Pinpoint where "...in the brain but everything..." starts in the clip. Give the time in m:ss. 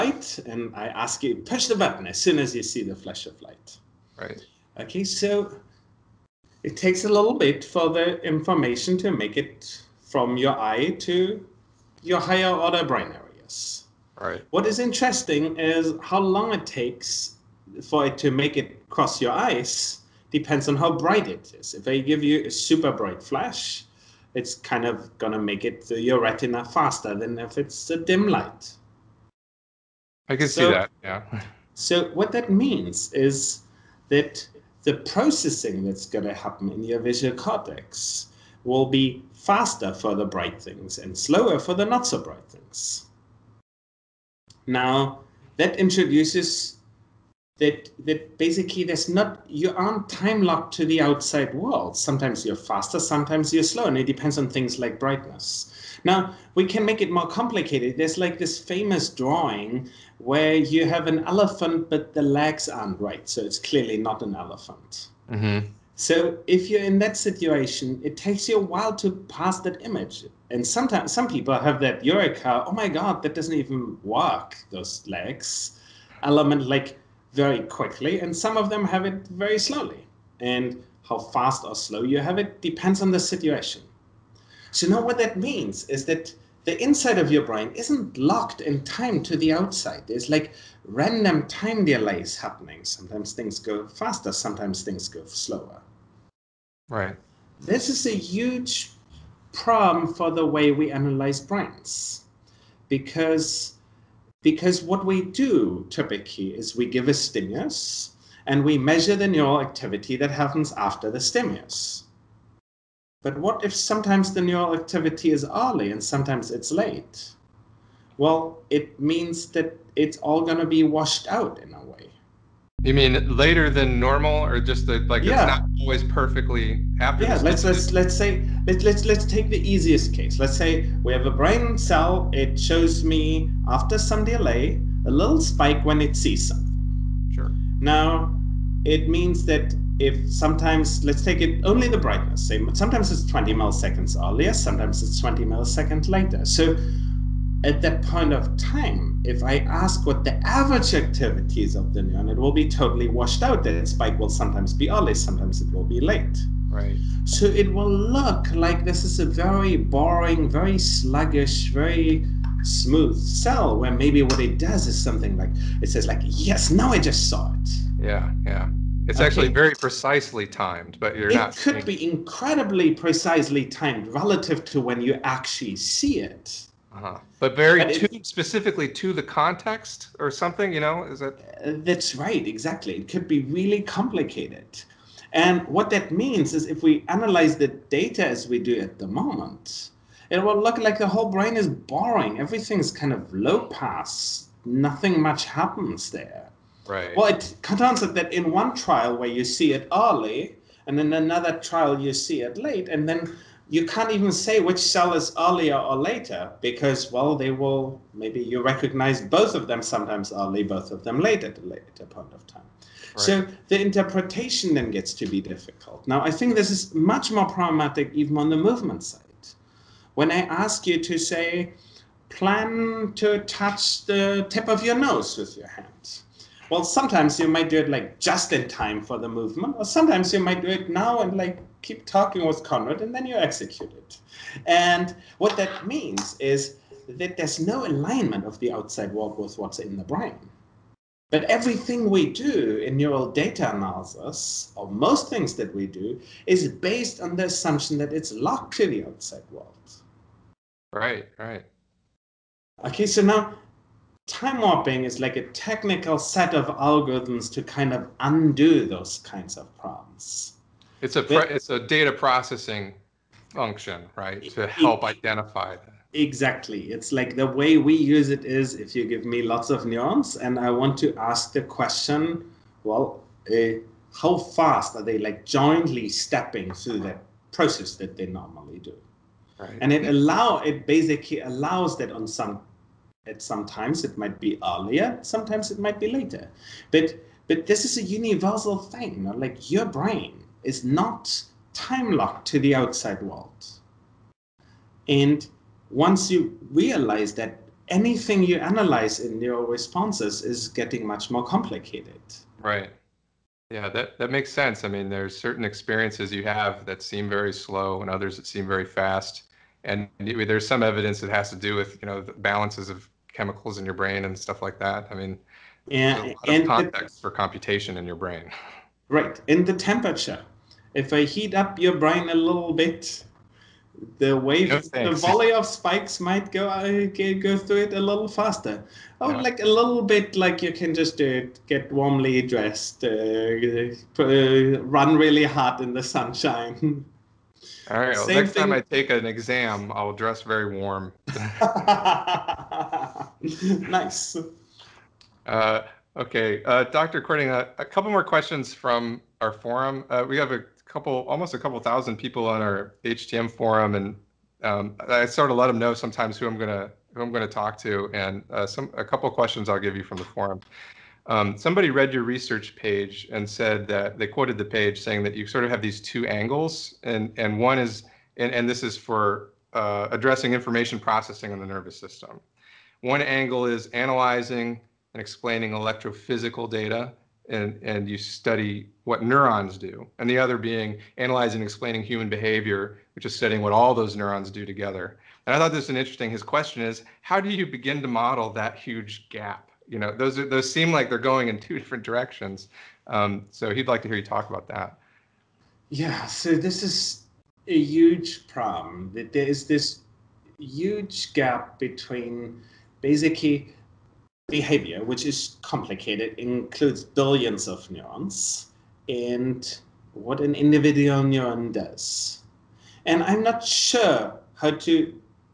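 3:59.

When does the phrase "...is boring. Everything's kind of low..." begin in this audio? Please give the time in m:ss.
3:11.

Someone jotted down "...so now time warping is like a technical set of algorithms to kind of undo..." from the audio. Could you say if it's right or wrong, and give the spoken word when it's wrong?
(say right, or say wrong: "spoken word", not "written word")
right.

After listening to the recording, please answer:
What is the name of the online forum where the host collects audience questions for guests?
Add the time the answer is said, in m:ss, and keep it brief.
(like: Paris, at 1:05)
HTM forum, at 5:53.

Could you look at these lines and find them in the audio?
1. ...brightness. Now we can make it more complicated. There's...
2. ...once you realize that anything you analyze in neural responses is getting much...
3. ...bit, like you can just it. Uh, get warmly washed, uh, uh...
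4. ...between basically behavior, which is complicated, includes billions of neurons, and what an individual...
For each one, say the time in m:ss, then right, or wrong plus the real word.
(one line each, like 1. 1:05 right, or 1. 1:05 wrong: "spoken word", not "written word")
1. 0:54 right
2. 4:55 right
3. 5:30 wrong: "dressed", not "washed"
4. 6:41 right.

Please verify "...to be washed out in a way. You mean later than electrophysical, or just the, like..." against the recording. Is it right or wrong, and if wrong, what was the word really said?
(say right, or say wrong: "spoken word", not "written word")
wrong: "normal", not "electrophysical".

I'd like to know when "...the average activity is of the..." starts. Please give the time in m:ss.
2:30.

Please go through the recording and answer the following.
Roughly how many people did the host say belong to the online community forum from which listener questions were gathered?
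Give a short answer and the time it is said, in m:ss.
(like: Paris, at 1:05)
a couple thousand, at 5:51.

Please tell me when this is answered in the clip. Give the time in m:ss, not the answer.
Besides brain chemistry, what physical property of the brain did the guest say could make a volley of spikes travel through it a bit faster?
5:19.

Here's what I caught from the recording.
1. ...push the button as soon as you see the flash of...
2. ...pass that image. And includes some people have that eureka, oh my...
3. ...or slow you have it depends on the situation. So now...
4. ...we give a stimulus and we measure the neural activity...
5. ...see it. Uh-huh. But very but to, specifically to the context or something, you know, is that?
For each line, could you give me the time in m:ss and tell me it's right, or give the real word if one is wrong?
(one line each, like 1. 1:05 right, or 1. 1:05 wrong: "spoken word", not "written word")
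1. 0:01 right
2. 1:09 wrong: "sometimes", not "includes"
3. 1:21 right
4. 1:46 right
5. 2:55 right.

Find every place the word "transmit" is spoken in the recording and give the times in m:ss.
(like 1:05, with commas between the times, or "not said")
not said.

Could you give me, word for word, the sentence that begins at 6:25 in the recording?
And I thought this was an interesting.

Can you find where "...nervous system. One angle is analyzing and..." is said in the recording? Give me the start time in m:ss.
6:11.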